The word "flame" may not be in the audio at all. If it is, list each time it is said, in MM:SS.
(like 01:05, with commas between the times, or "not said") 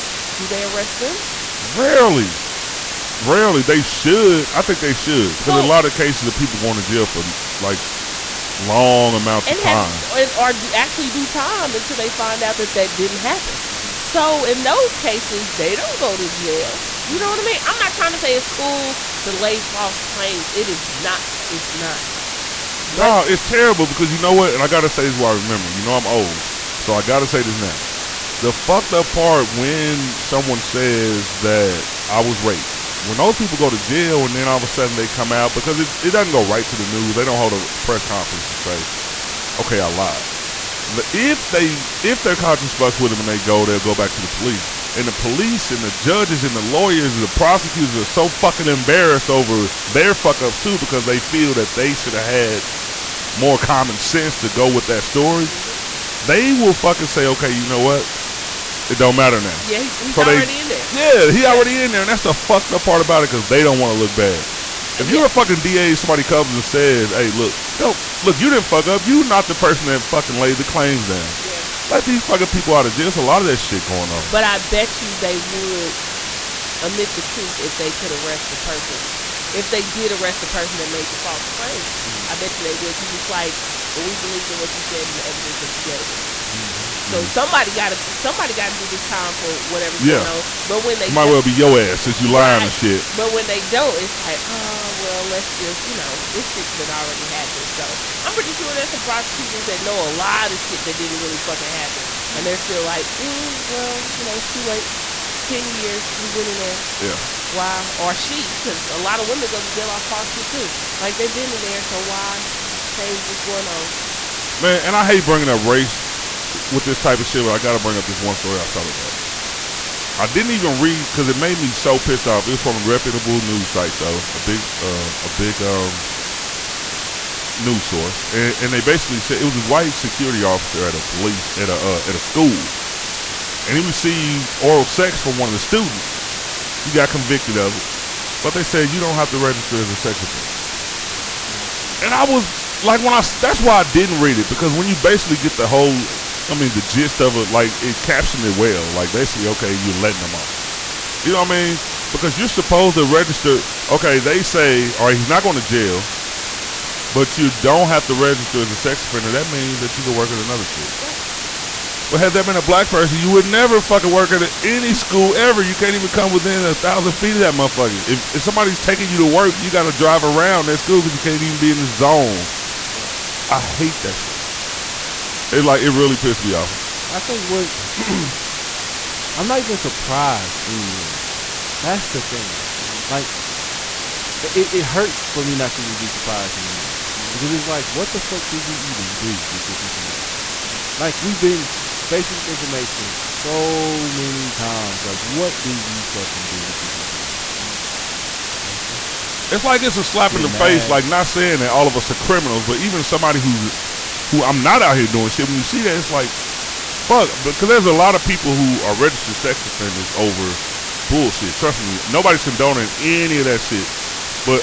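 not said.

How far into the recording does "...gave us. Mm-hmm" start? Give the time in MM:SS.
01:25.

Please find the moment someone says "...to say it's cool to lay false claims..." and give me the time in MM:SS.
00:18.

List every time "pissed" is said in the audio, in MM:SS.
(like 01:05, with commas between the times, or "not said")
02:02, 02:56.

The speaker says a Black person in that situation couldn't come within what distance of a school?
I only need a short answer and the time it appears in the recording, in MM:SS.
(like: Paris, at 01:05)
1000 feet, at 02:46.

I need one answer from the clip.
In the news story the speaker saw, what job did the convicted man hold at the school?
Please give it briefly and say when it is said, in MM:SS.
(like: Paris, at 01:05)
Security officer, at 02:09.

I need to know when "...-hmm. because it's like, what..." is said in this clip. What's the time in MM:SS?
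03:07.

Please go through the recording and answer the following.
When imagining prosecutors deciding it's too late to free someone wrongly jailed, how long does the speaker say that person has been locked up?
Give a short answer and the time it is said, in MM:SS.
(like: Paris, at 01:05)
10 years, at 01:45.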